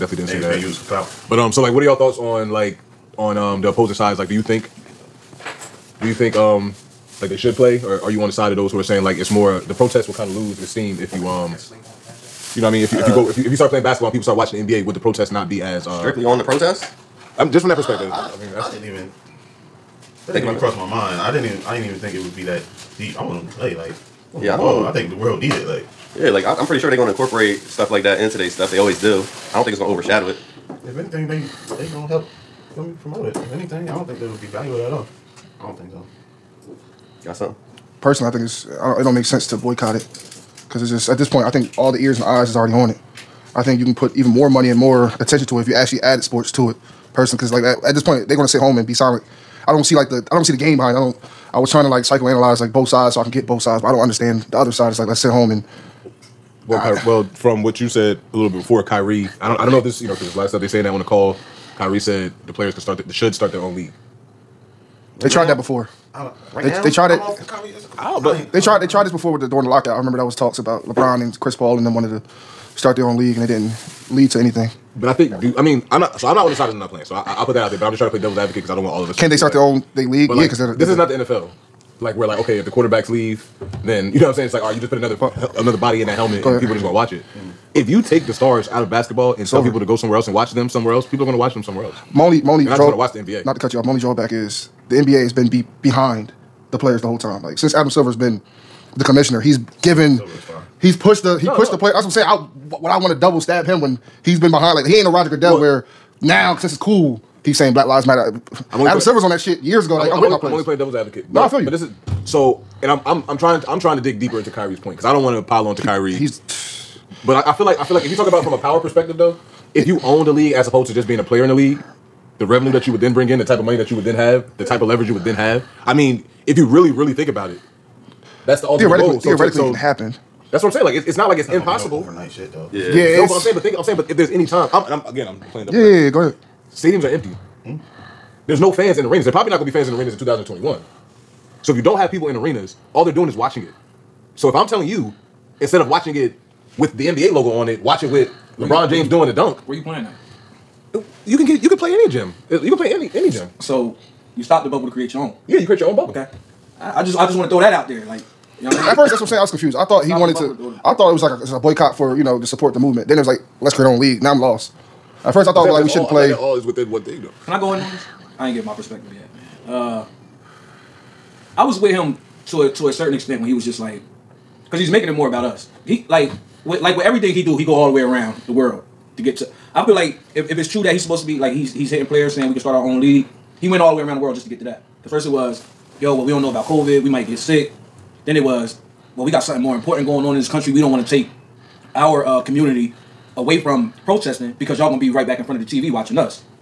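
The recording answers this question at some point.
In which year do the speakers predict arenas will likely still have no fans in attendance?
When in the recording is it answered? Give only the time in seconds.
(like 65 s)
140 s.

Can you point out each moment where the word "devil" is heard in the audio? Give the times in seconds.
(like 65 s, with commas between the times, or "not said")
78 s, 110 s.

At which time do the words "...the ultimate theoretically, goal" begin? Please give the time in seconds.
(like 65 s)
128 s.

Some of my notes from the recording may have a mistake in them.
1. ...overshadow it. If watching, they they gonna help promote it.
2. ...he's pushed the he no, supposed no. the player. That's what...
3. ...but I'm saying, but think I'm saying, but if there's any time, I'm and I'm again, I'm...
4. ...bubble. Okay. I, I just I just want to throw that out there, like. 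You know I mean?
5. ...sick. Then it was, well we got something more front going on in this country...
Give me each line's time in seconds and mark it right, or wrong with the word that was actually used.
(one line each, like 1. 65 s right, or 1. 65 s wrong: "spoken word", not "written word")
1. 29 s wrong: "anything", not "watching"
2. 100 s wrong: "pushed", not "supposed"
3. 133 s right
4. 155 s right
5. 187 s wrong: "important", not "front".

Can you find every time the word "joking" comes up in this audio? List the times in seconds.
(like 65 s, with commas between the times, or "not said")
not said.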